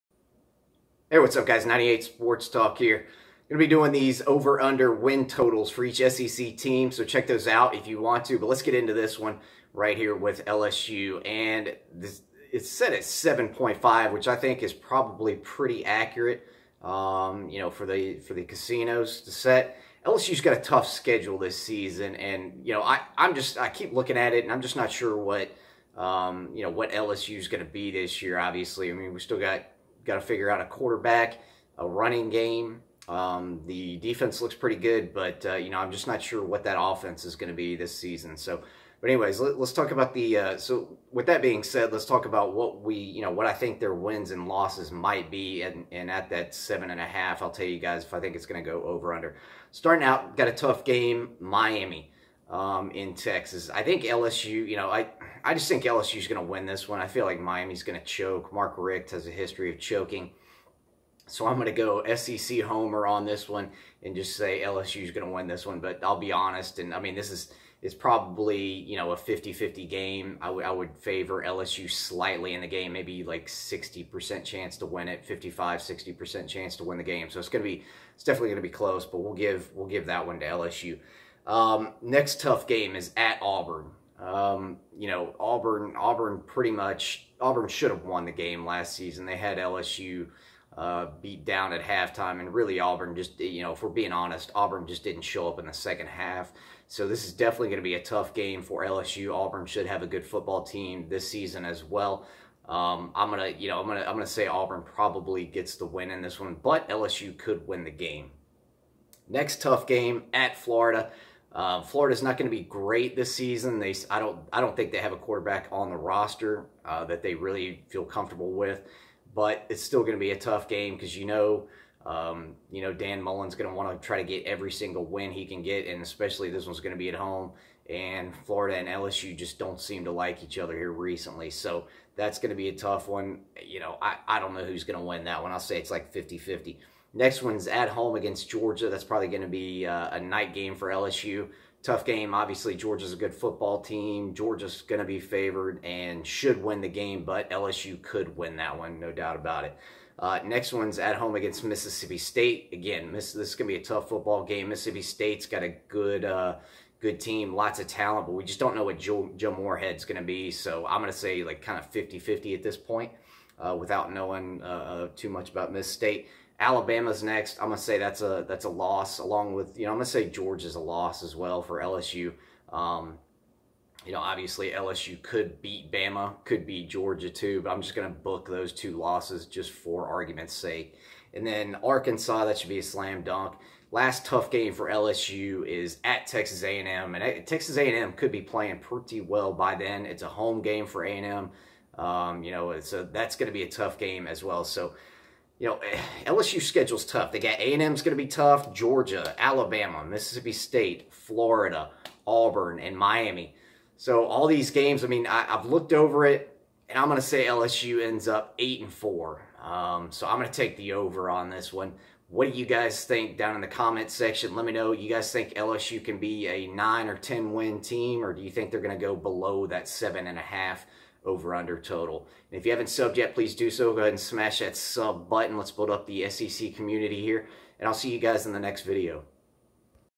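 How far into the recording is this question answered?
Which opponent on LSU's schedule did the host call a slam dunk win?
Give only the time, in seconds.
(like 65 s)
181 s.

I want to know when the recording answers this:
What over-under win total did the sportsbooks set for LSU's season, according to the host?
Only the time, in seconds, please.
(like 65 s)
13 s.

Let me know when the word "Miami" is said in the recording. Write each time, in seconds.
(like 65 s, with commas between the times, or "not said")
51 s, 57 s, 202 s.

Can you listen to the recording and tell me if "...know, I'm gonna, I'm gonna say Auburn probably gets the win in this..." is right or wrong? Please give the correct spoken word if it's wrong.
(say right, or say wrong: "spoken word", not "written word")
right.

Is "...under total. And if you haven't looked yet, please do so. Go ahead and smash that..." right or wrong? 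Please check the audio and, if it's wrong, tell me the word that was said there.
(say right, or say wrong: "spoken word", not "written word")
wrong: "subbed", not "looked".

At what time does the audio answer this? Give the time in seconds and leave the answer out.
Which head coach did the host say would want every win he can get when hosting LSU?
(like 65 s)
122 s.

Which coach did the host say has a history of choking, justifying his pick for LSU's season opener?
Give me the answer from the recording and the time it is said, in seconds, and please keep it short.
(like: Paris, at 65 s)
Mark Richt, at 58 s.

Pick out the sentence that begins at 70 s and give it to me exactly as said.
I, would favor LSU slightly in the game, maybe like 60% chance to win it, 55, 60% chance to win the game.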